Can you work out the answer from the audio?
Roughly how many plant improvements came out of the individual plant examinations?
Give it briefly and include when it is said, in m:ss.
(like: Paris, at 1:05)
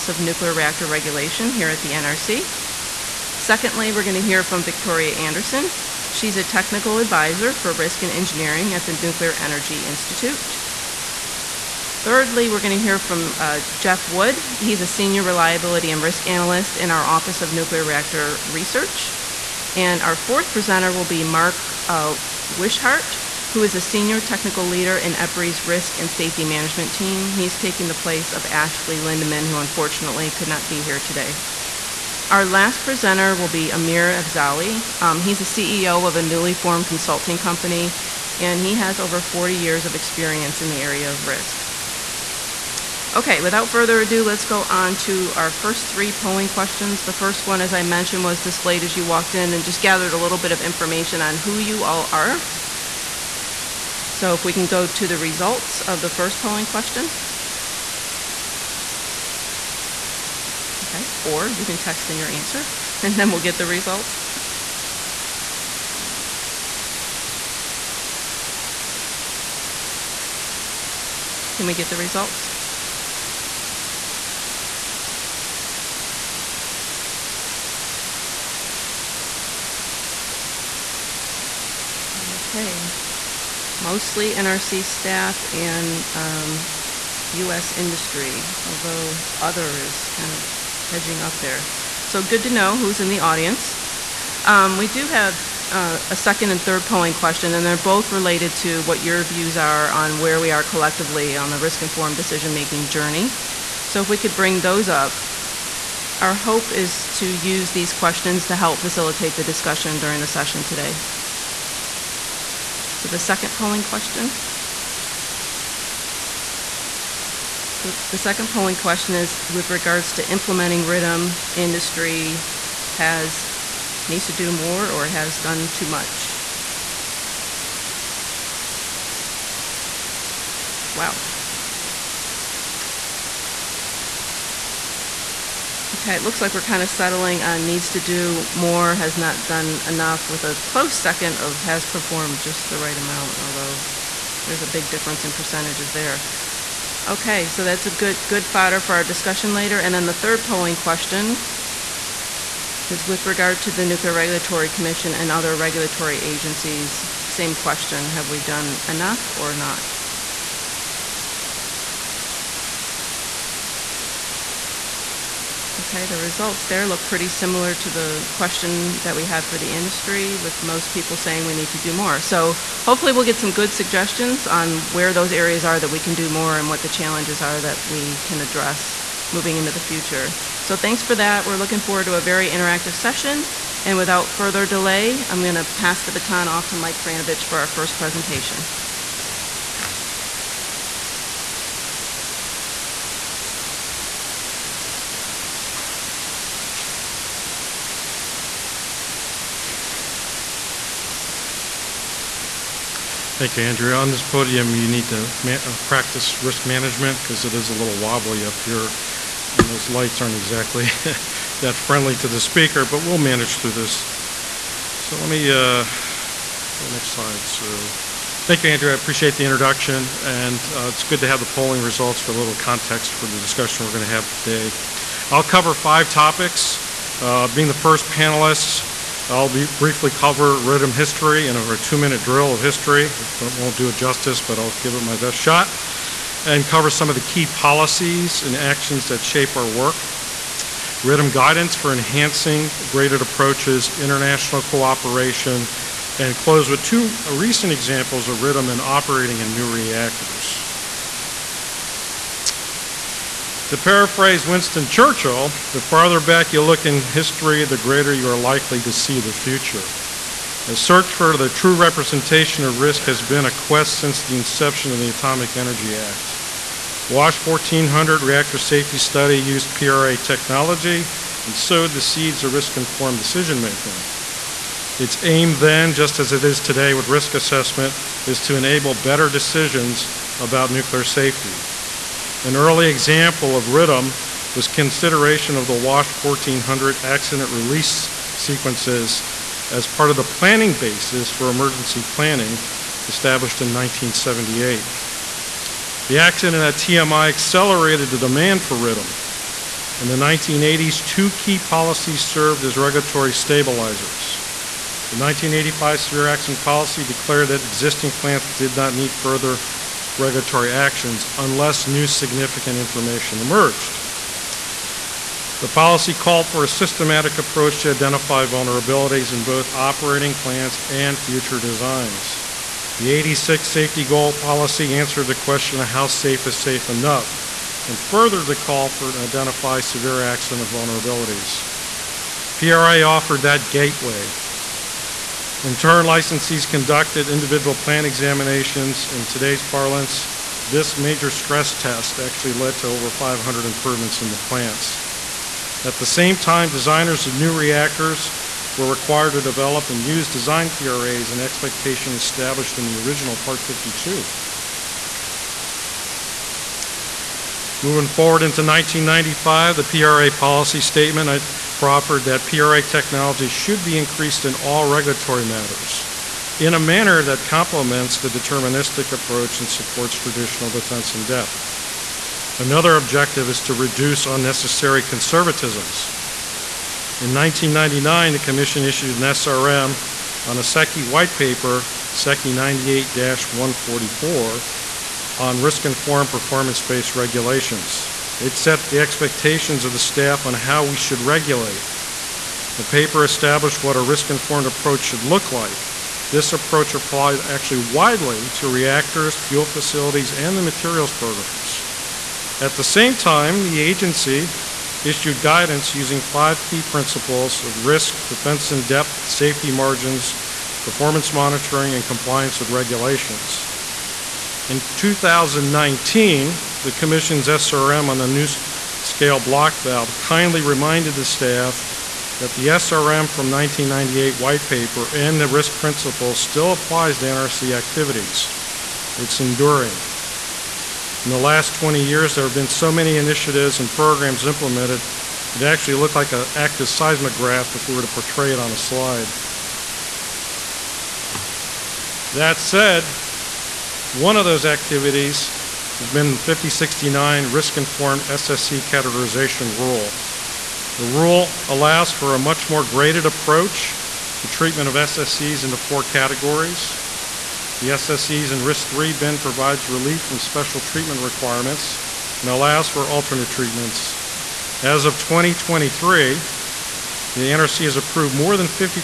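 over 500, at 5:42.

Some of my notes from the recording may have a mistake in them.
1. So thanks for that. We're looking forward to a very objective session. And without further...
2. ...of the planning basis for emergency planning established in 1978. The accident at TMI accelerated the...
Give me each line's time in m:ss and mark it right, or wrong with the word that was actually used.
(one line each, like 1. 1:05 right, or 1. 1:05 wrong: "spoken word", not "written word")
1. 3:00 wrong: "interactive", not "objective"
2. 4:50 right.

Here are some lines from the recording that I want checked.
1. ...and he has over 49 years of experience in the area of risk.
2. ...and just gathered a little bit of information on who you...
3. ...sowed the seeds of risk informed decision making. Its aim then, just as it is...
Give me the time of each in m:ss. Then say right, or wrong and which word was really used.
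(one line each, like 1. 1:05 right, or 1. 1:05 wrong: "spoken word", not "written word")
1. 0:38 wrong: "40", not "49"
2. 0:49 right
3. 4:31 right.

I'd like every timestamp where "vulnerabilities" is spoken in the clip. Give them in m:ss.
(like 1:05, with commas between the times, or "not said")
5:18, 5:30.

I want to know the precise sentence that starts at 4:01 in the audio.
RIDM guidance for enhancing graded approaches, international cooperation, and close with two recent examples of RIDM in operating in new reactors.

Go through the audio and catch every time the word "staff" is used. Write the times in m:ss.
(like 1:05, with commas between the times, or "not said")
1:24, 6:29, 7:01.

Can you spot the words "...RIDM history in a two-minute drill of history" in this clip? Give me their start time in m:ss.
3:50.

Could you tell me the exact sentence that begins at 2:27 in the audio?
Okay, so that's a good, good fodder for our discussion later.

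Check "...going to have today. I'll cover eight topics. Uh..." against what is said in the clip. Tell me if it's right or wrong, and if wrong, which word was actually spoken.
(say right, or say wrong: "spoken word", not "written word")
wrong: "five", not "eight".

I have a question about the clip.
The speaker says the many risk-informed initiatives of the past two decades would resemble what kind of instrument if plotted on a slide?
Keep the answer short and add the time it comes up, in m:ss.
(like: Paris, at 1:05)
active seismograph, at 7:16.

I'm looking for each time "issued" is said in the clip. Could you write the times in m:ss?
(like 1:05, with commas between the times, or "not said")
6:18, 6:45.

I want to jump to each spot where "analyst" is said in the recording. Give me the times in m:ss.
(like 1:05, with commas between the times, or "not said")
0:16.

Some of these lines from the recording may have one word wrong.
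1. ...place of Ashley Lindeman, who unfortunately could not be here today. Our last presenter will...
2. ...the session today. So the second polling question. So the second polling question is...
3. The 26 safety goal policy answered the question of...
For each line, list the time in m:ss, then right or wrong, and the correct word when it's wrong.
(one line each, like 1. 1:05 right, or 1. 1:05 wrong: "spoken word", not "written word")
1. 0:27 right
2. 1:50 right
3. 5:22 wrong: "86", not "26".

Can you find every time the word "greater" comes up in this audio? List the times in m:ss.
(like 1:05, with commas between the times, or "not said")
4:17.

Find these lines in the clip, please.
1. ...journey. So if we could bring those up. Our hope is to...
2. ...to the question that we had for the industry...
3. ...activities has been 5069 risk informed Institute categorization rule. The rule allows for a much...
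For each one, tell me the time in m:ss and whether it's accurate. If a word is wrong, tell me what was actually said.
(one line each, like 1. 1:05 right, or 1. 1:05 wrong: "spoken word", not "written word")
1. 1:42 right
2. 2:47 right
3. 7:24 wrong: "SSC", not "Institute".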